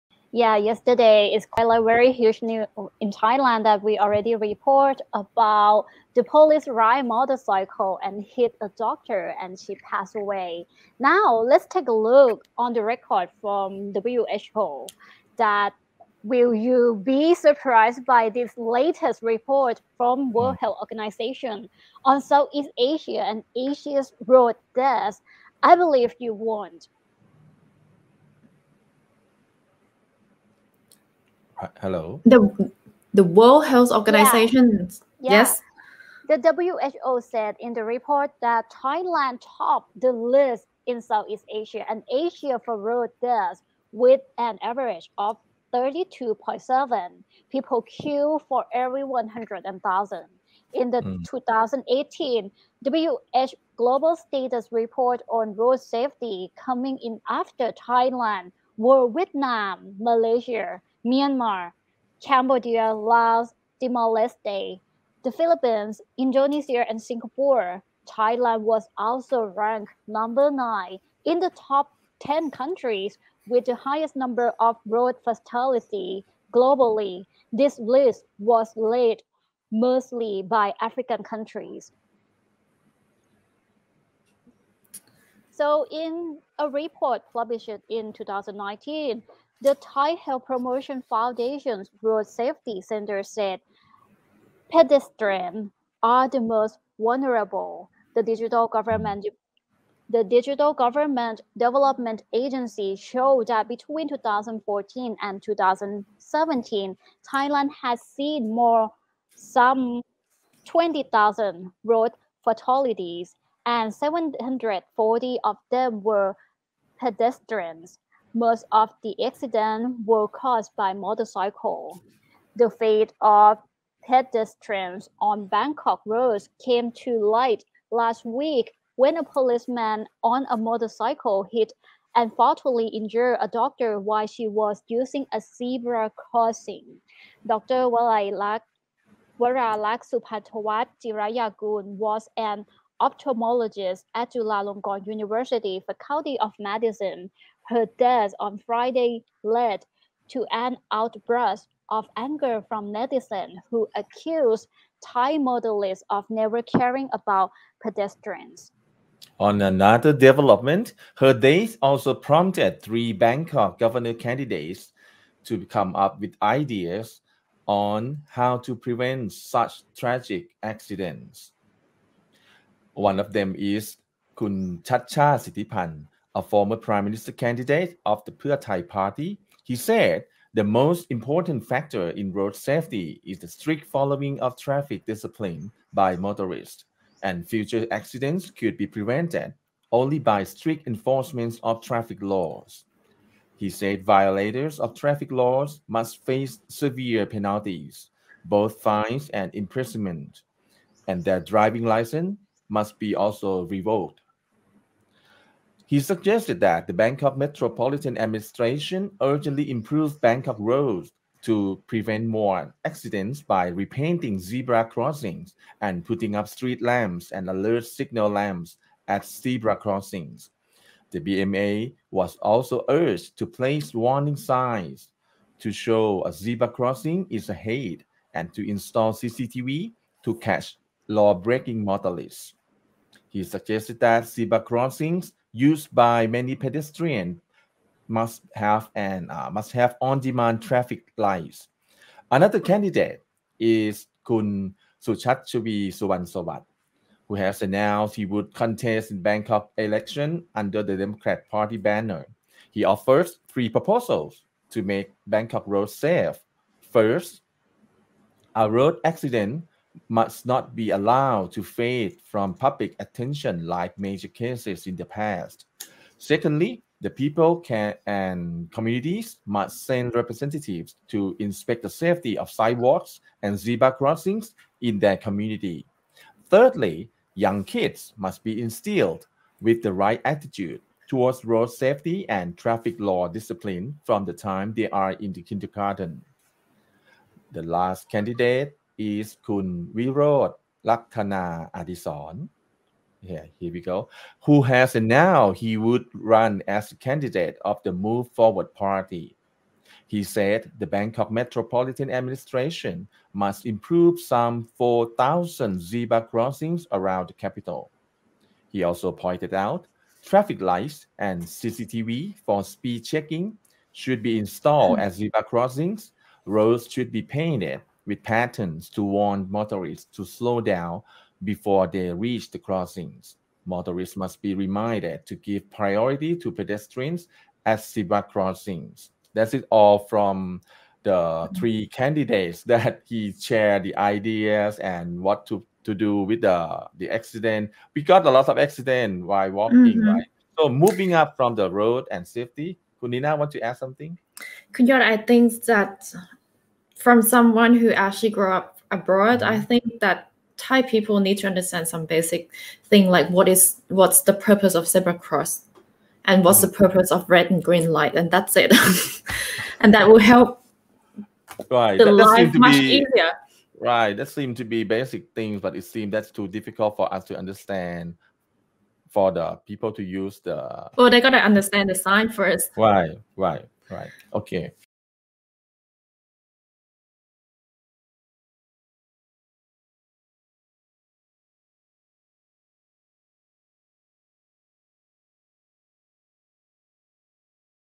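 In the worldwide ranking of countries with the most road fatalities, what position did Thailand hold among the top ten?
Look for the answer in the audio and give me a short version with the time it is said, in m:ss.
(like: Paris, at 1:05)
9, at 1:10.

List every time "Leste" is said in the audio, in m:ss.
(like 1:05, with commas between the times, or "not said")
1:04.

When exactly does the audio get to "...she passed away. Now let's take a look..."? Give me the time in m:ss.
0:09.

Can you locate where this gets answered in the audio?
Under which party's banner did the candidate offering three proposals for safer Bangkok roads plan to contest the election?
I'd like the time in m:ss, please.
4:10.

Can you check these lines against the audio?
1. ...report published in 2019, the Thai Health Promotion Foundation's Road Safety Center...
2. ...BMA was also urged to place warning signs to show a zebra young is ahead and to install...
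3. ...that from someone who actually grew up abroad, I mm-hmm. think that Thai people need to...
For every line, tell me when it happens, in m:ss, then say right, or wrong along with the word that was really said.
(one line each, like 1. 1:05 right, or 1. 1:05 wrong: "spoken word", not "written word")
1. 1:26 right
2. 3:41 wrong: "crossing", not "young"
3. 5:45 right.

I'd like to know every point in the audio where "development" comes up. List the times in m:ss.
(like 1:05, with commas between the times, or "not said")
1:41, 2:40.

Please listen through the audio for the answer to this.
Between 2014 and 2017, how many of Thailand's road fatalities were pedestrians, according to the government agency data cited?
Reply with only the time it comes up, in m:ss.
1:53.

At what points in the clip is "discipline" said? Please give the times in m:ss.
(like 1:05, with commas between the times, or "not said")
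3:05, 4:43.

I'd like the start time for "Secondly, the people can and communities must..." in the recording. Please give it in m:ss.
4:26.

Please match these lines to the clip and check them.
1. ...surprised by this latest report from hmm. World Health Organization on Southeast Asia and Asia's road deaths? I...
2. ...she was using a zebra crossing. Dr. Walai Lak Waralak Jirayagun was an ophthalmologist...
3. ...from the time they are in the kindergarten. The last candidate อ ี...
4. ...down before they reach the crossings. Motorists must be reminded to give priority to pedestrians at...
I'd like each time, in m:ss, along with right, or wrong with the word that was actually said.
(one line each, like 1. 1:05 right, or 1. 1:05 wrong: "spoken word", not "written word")
1. 0:17 right
2. 2:14 right
3. 4:44 right
4. 5:20 right.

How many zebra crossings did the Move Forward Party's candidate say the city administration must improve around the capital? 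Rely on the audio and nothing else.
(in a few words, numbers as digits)
4,000.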